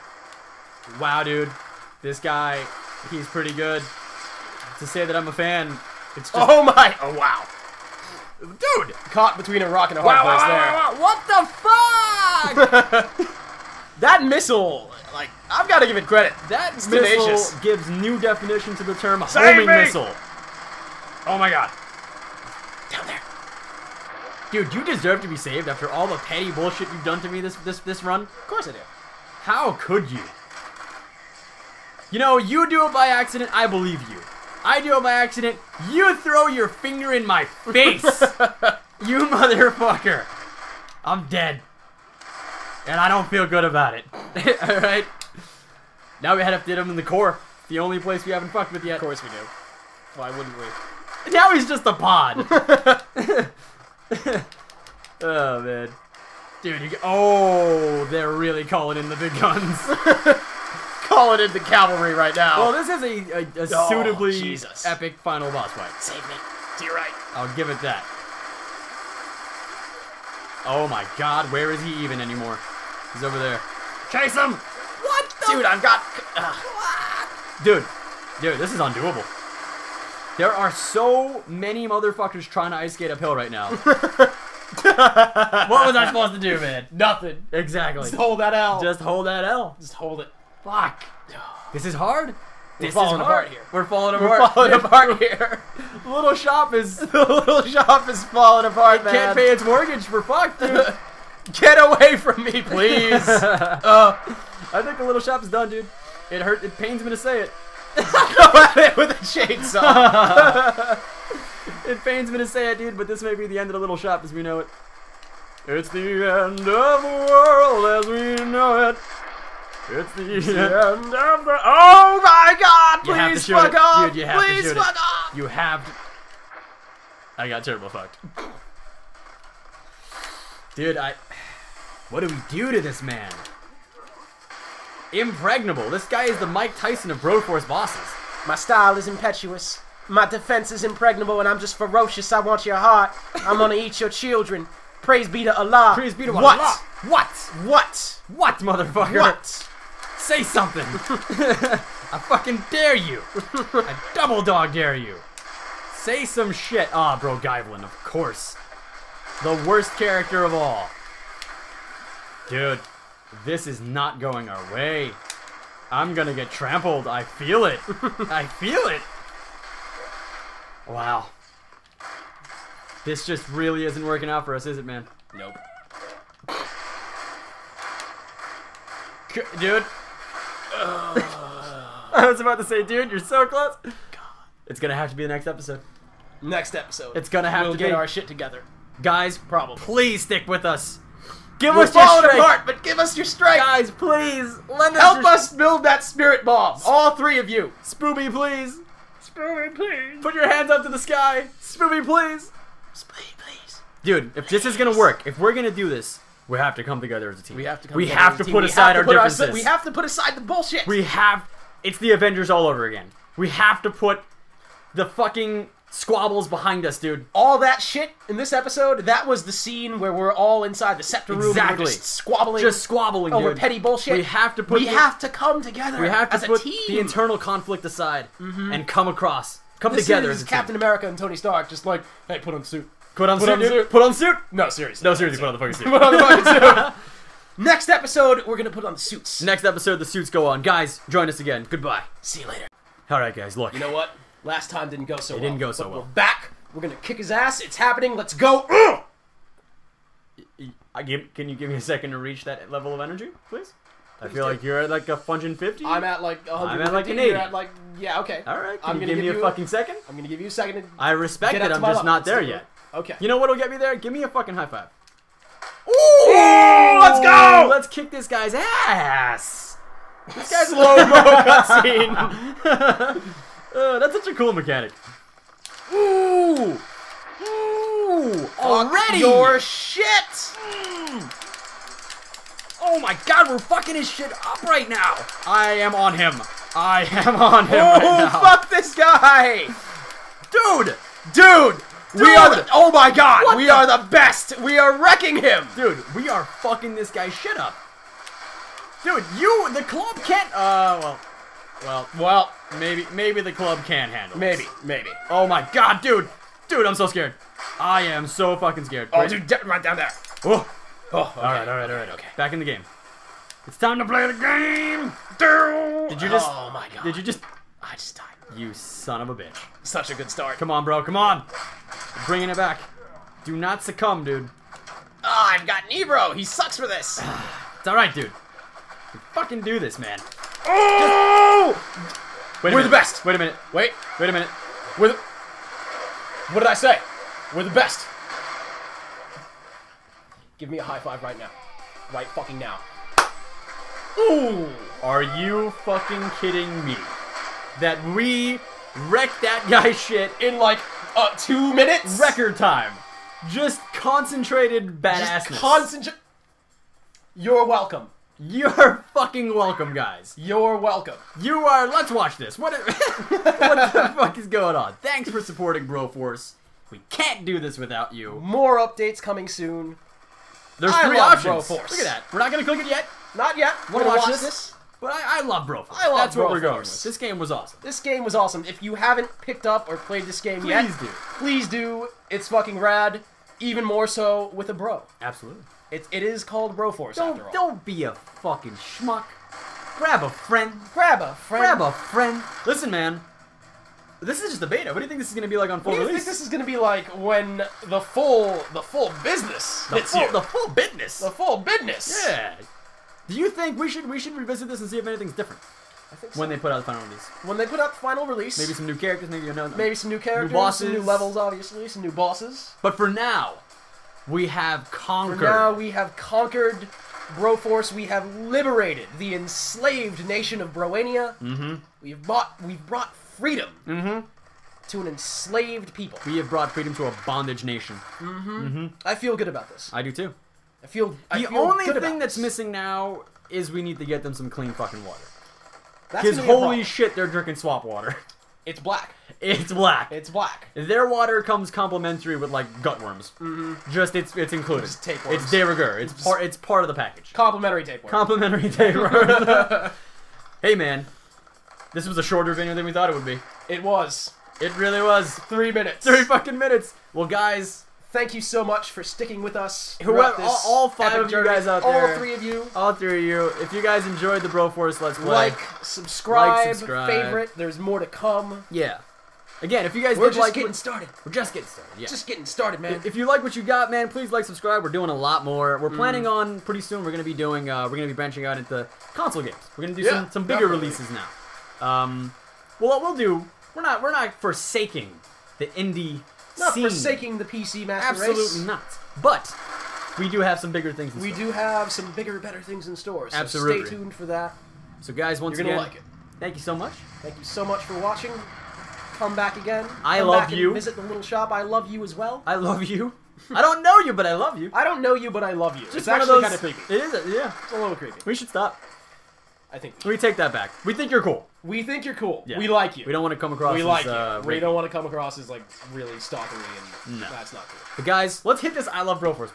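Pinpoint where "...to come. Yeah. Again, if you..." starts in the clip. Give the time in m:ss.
7:47.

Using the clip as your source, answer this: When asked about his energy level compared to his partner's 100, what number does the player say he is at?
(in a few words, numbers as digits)
80.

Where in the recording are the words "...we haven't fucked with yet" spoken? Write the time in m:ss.
0:48.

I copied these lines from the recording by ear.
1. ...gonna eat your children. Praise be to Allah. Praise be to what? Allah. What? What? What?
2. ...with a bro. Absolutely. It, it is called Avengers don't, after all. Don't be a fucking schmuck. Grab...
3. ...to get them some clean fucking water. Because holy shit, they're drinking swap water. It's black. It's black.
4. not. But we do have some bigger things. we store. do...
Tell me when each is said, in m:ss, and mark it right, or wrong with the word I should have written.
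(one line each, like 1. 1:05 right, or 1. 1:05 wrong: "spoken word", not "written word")
1. 2:23 right
2. 6:24 wrong: "Broforce", not "Avengers"
3. 7:13 right
4. 8:08 right.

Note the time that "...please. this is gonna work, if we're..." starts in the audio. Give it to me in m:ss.
3:24.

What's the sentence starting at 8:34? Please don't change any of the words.
Uh, we don't want to come across as like really stalkery, and no.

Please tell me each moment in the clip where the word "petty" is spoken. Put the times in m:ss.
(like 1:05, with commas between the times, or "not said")
0:26, 3:43.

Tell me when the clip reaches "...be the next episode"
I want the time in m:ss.
3:05.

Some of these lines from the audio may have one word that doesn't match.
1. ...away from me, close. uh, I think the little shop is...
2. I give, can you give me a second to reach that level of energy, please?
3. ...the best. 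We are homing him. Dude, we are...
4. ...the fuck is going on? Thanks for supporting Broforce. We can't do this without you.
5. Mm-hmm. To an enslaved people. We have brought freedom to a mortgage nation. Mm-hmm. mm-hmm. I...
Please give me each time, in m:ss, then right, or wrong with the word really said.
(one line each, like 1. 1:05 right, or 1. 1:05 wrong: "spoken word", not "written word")
1. 1:41 wrong: "please", not "close"
2. 4:10 right
3. 4:53 wrong: "wrecking", not "homing"
4. 6:03 right
5. 7:03 wrong: "bondage", not "mortgage".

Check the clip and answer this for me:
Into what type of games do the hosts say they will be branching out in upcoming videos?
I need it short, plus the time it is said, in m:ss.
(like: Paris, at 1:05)
console games, at 7:59.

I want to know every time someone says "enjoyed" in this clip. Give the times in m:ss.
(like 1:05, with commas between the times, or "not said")
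7:44.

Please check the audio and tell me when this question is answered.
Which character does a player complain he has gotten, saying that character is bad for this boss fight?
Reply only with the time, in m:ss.
5:25.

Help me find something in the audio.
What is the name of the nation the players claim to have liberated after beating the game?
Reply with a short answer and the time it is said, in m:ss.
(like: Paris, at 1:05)
Broania, at 7:00.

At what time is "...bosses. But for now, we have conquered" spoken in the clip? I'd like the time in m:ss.
6:52.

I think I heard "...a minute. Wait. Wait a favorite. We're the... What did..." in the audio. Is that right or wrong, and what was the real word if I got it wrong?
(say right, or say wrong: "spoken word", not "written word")
wrong: "minute", not "favorite".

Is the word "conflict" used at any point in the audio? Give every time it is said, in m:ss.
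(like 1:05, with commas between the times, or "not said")
3:47.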